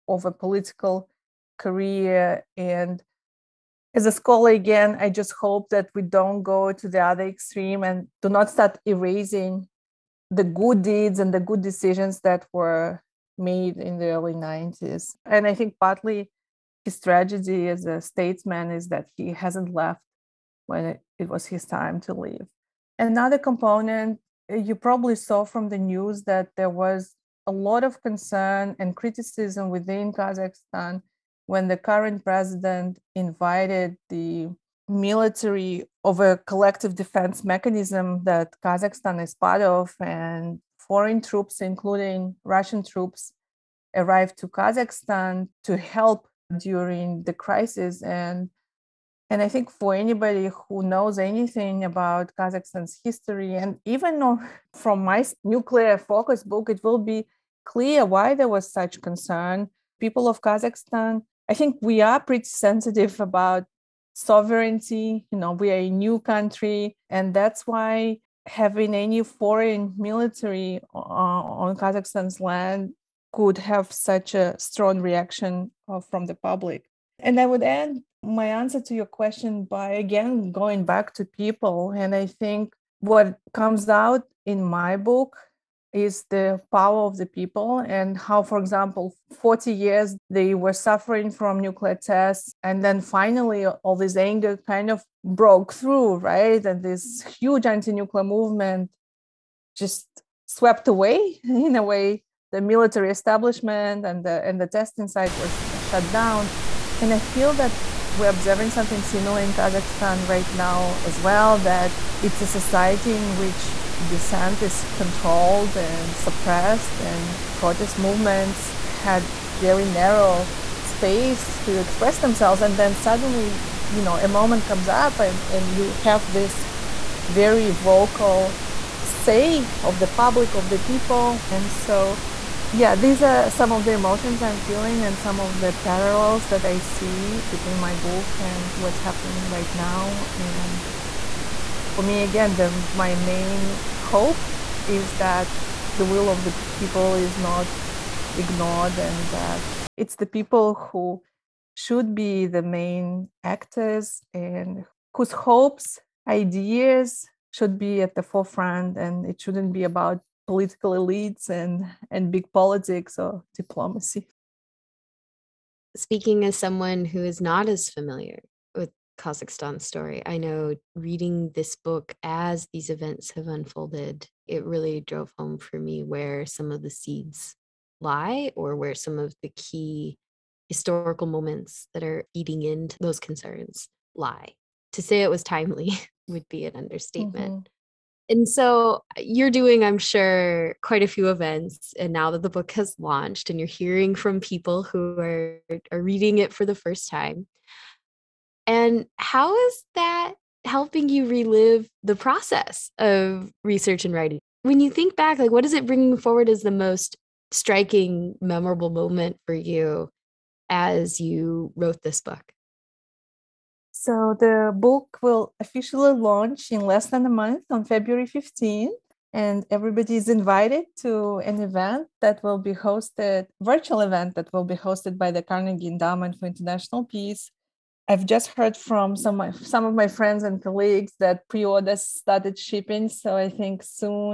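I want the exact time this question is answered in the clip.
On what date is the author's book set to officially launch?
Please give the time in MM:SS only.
03:37.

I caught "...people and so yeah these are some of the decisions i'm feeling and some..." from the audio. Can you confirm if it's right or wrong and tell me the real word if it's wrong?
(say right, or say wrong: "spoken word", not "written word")
wrong: "emotions", not "decisions".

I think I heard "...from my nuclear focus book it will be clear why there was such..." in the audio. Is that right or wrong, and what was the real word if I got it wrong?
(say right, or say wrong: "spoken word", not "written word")
right.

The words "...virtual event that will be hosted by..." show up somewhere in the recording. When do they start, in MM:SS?
03:43.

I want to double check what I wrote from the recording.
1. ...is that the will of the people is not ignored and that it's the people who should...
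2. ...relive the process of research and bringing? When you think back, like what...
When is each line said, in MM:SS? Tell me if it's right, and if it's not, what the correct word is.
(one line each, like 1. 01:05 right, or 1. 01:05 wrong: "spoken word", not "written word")
1. 02:24 right
2. 03:21 wrong: "writing", not "bringing".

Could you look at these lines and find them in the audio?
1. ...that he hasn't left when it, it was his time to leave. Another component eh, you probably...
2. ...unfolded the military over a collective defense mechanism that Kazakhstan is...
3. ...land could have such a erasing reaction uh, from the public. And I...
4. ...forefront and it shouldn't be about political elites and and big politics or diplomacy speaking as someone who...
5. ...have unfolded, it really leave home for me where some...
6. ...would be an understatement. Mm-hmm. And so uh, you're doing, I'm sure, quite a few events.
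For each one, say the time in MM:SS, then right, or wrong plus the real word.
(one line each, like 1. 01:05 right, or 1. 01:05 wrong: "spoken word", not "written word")
1. 00:18 right
2. 00:33 wrong: "invited", not "unfolded"
3. 01:12 wrong: "strong", not "erasing"
4. 02:38 right
5. 02:53 wrong: "drove", not "leave"
6. 03:06 right.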